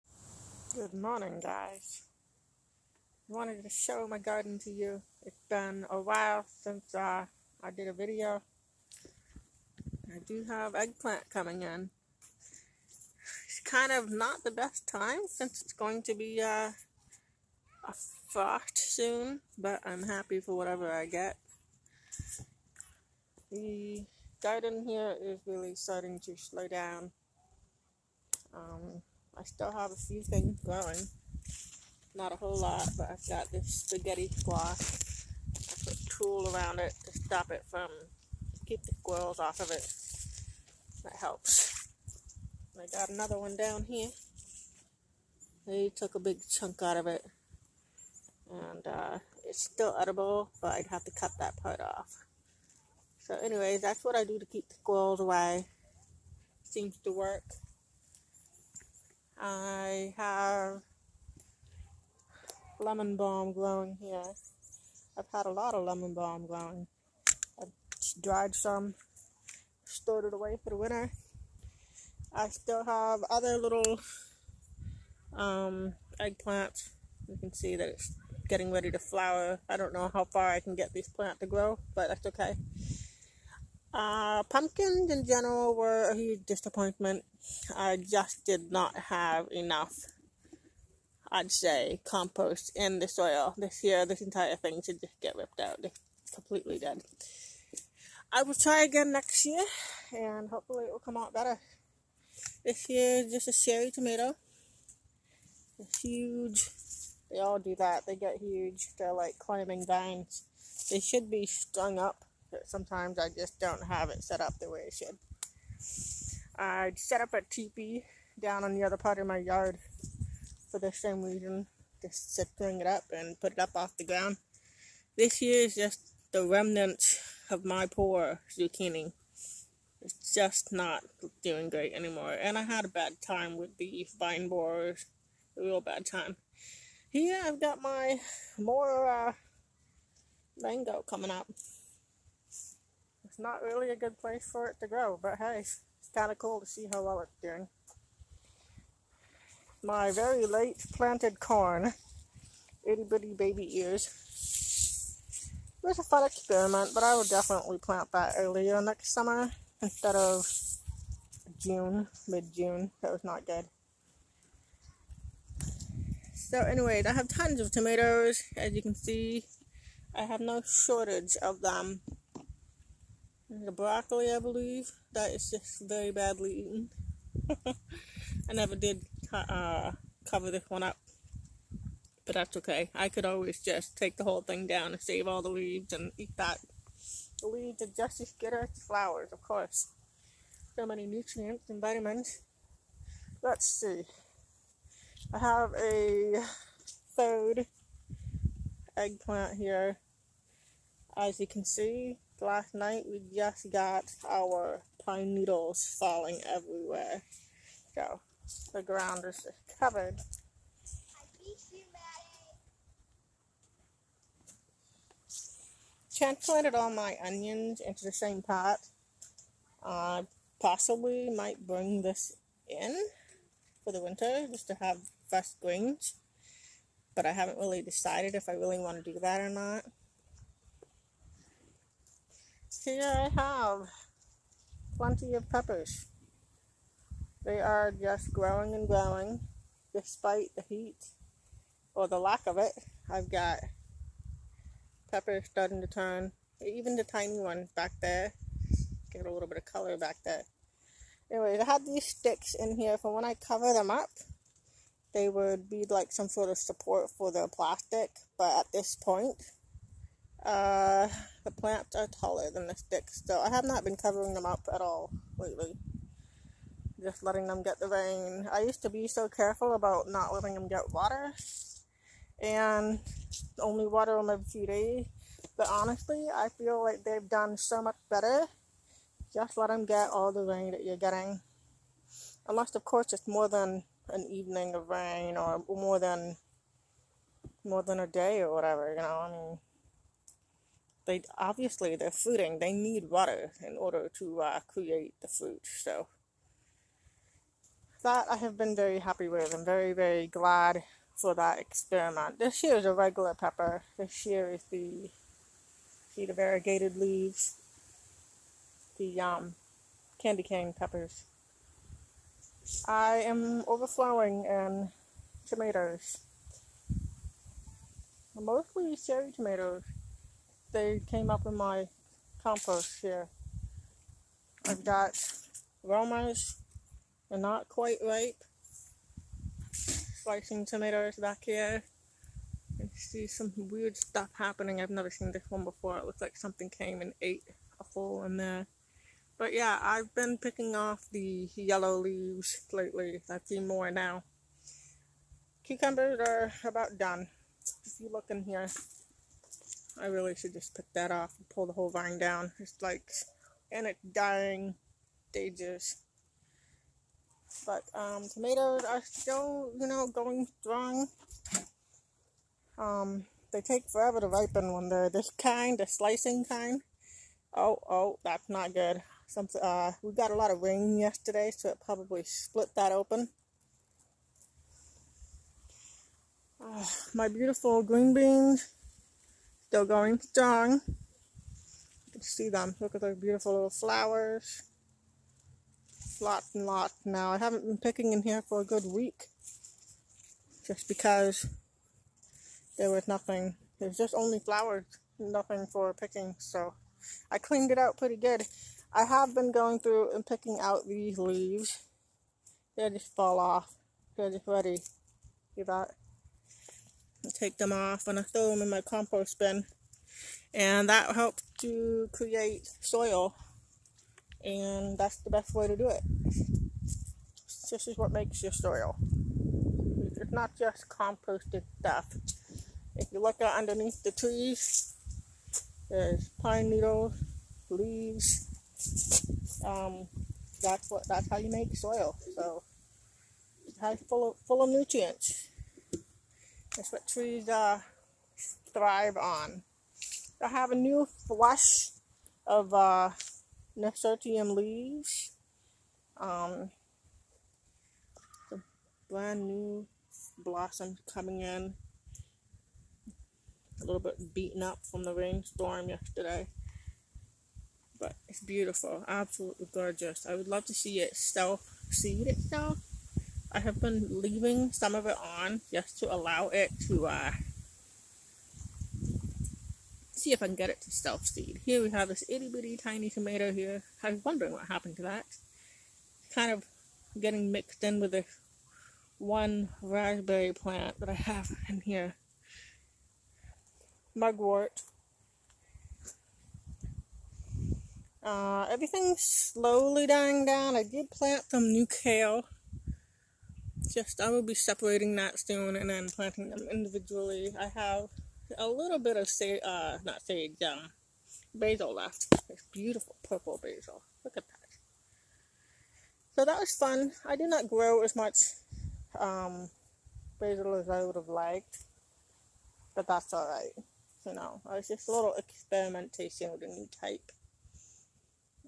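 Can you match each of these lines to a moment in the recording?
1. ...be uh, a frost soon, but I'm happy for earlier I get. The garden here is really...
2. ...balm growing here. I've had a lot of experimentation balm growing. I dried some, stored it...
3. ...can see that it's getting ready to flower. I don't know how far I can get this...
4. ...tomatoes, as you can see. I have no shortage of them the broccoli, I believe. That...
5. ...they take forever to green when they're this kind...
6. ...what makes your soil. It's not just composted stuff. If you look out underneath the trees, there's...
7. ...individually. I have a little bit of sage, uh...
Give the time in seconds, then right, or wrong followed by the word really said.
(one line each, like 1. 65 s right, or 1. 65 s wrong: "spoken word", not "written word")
1. 16 s wrong: "whatever", not "earlier"
2. 63 s wrong: "lemon", not "experimentation"
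3. 77 s right
4. 167 s right
5. 363 s wrong: "ripen", not "green"
6. 417 s right
7. 496 s right.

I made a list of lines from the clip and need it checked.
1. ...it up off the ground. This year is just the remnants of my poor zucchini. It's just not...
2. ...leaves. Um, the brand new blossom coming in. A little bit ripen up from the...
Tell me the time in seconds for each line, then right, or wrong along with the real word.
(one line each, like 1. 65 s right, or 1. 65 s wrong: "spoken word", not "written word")
1. 123 s right
2. 444 s wrong: "beaten", not "ripen".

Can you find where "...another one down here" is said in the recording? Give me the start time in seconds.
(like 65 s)
43 s.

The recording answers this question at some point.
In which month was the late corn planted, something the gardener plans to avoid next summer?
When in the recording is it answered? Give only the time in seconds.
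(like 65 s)
161 s.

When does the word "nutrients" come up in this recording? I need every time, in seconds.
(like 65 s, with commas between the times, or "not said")
191 s, 434 s.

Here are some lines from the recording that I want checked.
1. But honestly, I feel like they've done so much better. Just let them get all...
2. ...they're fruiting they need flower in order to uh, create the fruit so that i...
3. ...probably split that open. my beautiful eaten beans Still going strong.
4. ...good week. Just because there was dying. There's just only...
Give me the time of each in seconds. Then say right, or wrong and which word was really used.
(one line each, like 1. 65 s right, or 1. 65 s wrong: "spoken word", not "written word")
1. 275 s right
2. 291 s wrong: "water", not "flower"
3. 371 s wrong: "green", not "eaten"
4. 388 s wrong: "nothing", not "dying".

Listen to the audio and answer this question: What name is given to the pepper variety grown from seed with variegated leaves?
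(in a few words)
candy cane peppers.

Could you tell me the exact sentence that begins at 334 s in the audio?
I've never seen this one before.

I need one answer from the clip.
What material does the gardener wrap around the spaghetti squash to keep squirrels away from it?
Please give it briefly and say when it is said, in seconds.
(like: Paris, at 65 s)
tulle, at 36 s.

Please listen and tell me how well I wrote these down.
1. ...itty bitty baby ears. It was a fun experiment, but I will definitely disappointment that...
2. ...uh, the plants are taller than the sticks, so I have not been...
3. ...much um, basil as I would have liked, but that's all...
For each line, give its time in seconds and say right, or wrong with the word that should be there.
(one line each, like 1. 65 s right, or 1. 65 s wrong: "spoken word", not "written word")
1. 152 s wrong: "plant", not "disappointment"
2. 260 s right
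3. 508 s right.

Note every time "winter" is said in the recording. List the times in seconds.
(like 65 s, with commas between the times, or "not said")
70 s, 224 s.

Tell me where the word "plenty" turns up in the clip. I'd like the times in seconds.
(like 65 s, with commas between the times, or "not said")
234 s.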